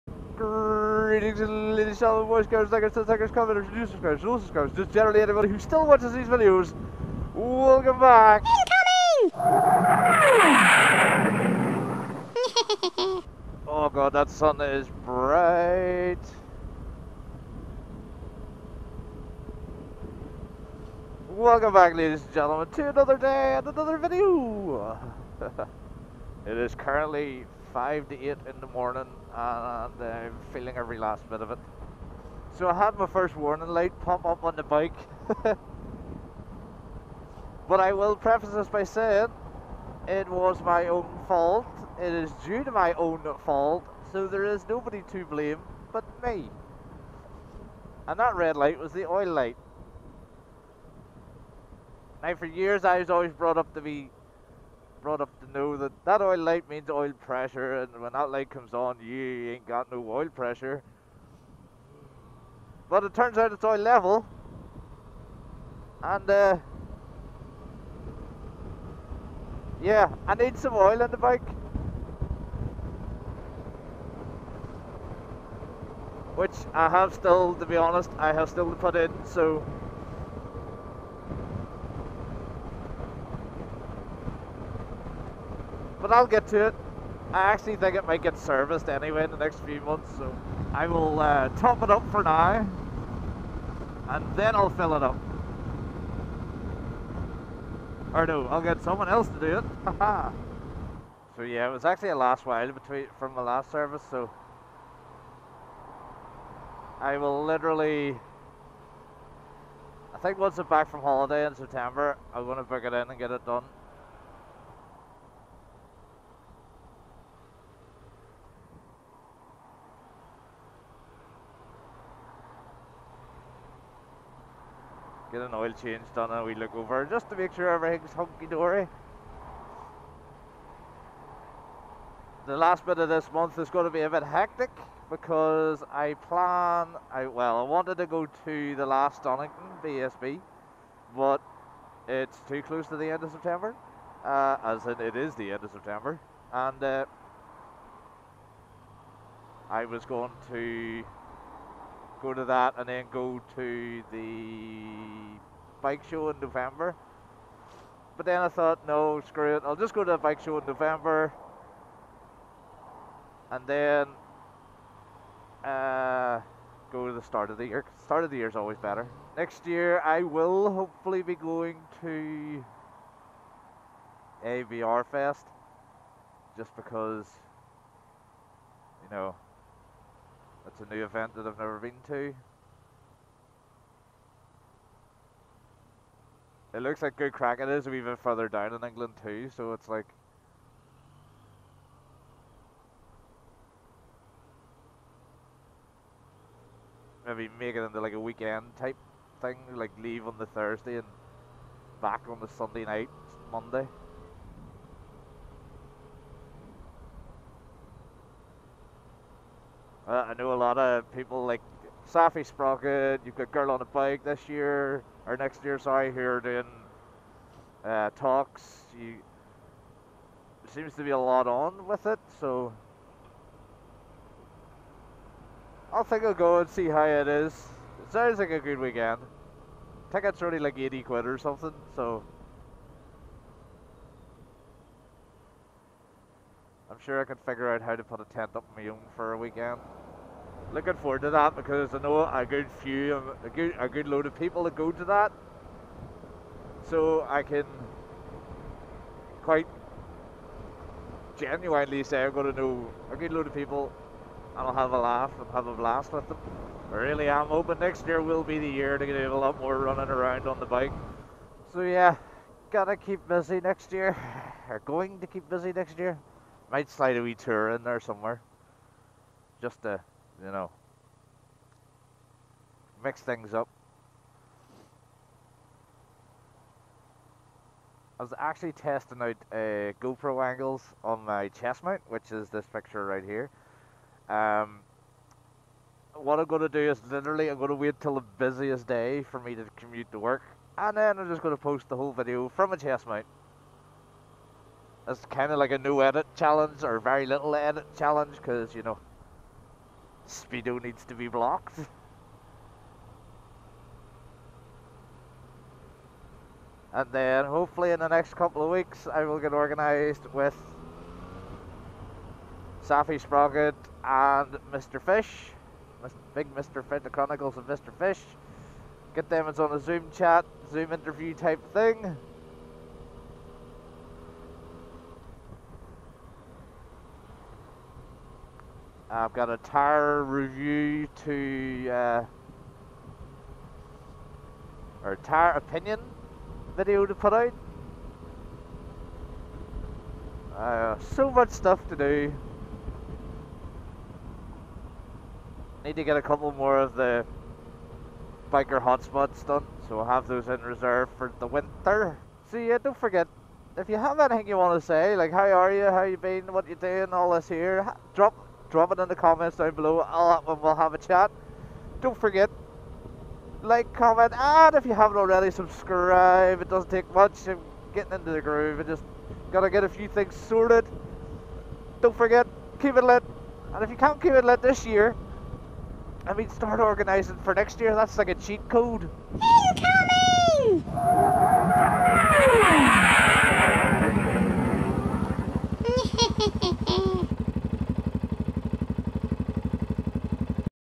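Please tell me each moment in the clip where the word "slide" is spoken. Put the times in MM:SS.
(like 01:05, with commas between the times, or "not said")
04:26.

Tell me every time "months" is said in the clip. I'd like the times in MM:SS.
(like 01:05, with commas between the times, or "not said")
01:29, 02:13.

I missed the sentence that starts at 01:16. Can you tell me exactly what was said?
Which I have still, to be honest, I have still to put in, so but I'll get to it.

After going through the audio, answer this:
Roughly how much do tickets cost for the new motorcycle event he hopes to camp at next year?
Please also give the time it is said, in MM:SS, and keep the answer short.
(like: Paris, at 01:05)
80 quid, at 03:50.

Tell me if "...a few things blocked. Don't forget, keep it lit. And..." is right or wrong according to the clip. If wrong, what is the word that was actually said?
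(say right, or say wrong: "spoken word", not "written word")
wrong: "sorted", not "blocked".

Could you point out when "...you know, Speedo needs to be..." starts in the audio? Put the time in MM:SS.
04:58.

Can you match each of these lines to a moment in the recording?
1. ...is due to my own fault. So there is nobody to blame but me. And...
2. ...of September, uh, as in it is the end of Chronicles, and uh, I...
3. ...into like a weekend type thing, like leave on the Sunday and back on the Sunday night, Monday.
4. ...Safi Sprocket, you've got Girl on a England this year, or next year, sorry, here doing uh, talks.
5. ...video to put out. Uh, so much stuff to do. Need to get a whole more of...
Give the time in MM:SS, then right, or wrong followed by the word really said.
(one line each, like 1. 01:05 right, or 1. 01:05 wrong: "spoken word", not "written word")
1. 00:42 right
2. 02:23 wrong: "September", not "Chronicles"
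3. 03:17 wrong: "Thursday", not "Sunday"
4. 03:32 wrong: "Bike", not "England"
5. 05:36 wrong: "couple", not "whole".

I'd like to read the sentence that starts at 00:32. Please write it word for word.
So I had my first warning light pop up on the bike.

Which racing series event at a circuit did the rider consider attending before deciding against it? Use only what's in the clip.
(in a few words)
Donington BSB.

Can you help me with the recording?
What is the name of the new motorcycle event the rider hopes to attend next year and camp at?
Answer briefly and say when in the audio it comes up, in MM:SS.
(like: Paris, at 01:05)
ABR Fest, at 02:54.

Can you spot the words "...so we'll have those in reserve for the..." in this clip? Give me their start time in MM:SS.
05:49.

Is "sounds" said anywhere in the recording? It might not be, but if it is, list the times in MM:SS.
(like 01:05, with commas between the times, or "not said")
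03:48.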